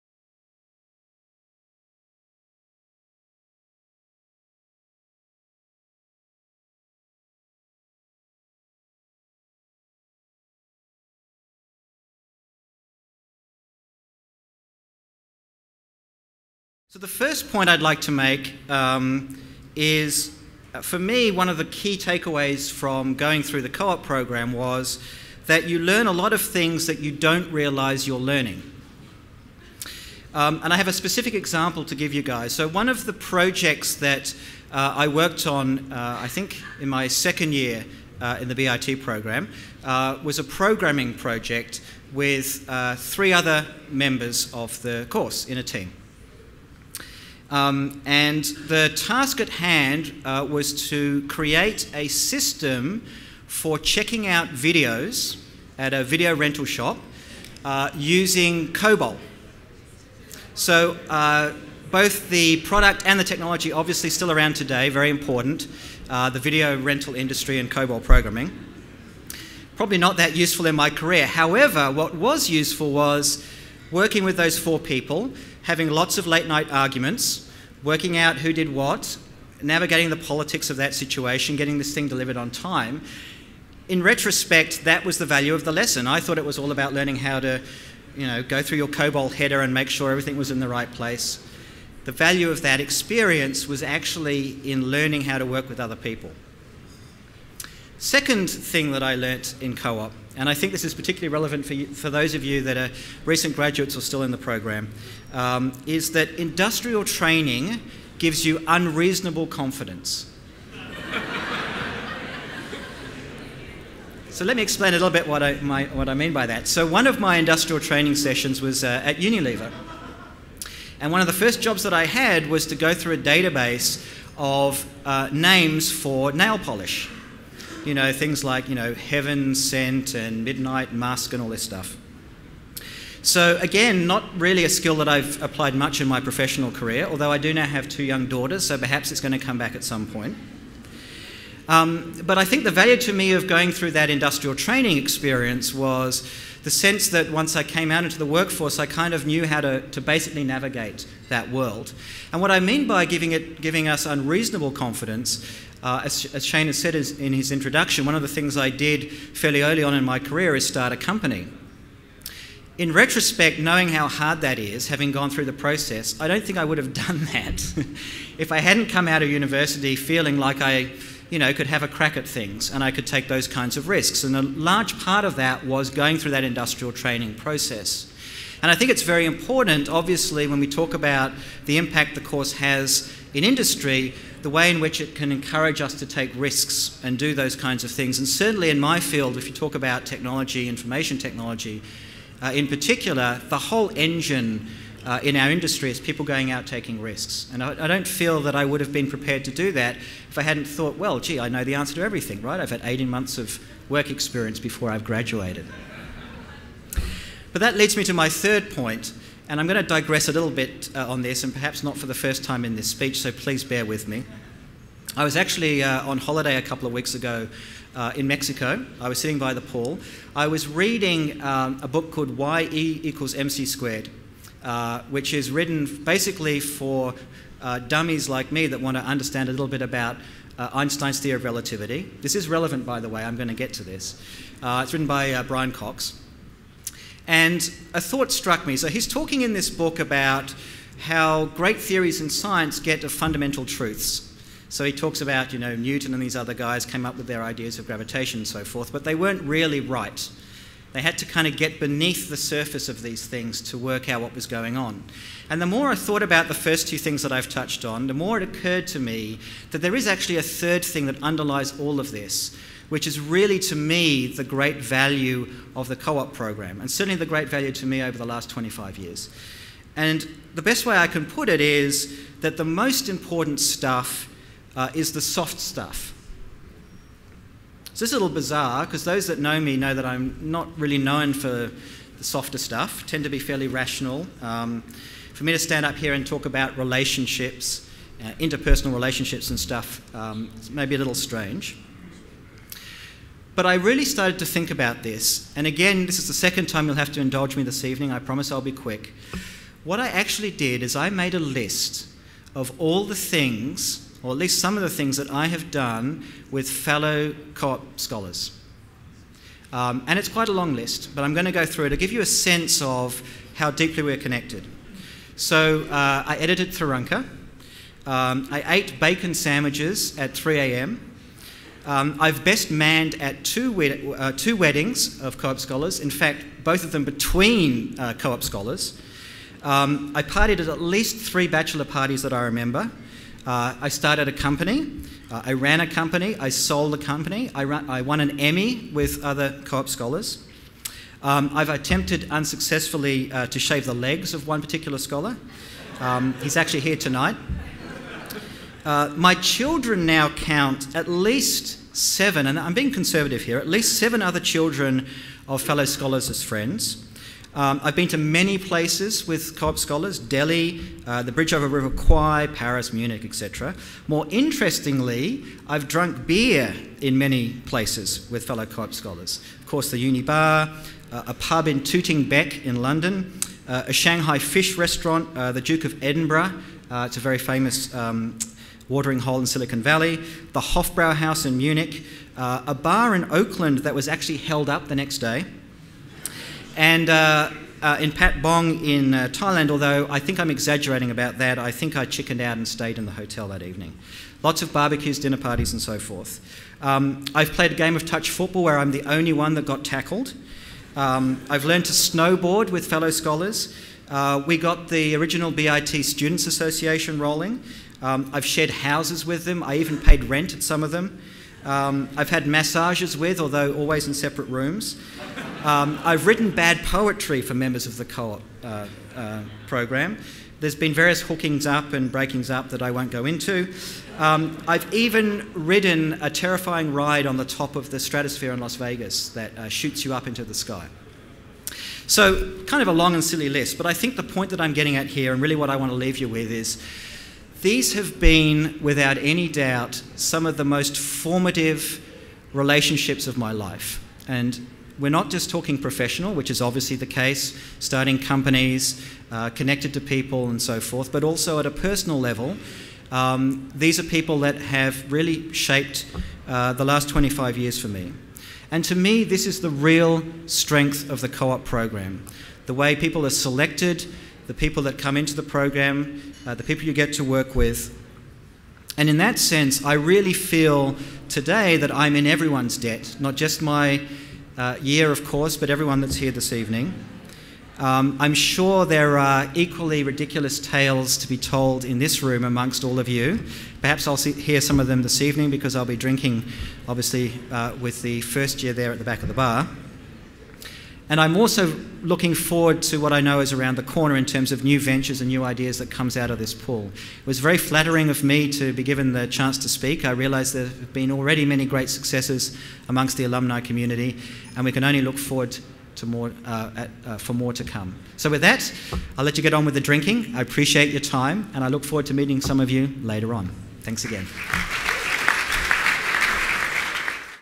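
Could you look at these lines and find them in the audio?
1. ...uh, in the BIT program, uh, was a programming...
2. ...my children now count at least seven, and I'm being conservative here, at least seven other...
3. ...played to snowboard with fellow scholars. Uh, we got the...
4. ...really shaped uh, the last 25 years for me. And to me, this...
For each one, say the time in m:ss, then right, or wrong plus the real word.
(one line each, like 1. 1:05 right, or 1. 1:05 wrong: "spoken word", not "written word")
1. 0:38 right
2. 5:49 right
3. 6:41 wrong: "learned", not "played"
4. 7:35 right.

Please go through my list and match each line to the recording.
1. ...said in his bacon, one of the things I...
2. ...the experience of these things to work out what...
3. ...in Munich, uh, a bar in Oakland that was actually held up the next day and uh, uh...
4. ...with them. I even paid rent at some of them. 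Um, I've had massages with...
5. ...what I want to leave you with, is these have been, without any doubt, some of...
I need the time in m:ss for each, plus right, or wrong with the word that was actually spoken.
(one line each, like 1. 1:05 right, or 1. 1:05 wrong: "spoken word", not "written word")
1. 2:36 wrong: "introduction", not "bacon"
2. 4:12 wrong: "surface", not "experience"
3. 6:21 right
4. 6:49 right
5. 7:15 right.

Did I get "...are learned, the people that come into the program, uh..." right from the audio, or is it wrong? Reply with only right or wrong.
wrong.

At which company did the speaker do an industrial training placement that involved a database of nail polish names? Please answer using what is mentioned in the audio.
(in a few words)
Unilever.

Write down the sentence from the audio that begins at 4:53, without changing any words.
But I really started to think about this, and again, this is the second time you'll have to indulge me this evening.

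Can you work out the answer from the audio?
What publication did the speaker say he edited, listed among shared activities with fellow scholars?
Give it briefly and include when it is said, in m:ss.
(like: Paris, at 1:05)
Tharunka, at 5:16.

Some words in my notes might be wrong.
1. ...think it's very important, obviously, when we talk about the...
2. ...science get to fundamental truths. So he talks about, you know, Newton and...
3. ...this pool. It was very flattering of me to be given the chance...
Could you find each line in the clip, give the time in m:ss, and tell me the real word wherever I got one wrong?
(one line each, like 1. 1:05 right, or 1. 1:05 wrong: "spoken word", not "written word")
1. 2:58 right
2. 4:02 right
3. 8:16 right.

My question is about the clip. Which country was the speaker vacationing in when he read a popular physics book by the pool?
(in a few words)
Mexico.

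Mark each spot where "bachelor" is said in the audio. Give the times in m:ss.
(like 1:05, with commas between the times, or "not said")
5:31.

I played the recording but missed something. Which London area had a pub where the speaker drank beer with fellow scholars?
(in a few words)
Tooting Bec.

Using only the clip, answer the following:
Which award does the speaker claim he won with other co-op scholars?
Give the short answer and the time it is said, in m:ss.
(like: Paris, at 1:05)
Emmy, at 5:38.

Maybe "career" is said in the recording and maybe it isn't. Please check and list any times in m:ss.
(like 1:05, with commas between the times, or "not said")
1:10, 2:16, 2:40.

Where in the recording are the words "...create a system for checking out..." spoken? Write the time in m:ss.
0:51.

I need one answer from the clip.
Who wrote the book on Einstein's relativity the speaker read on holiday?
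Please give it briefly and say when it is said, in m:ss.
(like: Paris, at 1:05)
Brian Cox, at 3:55.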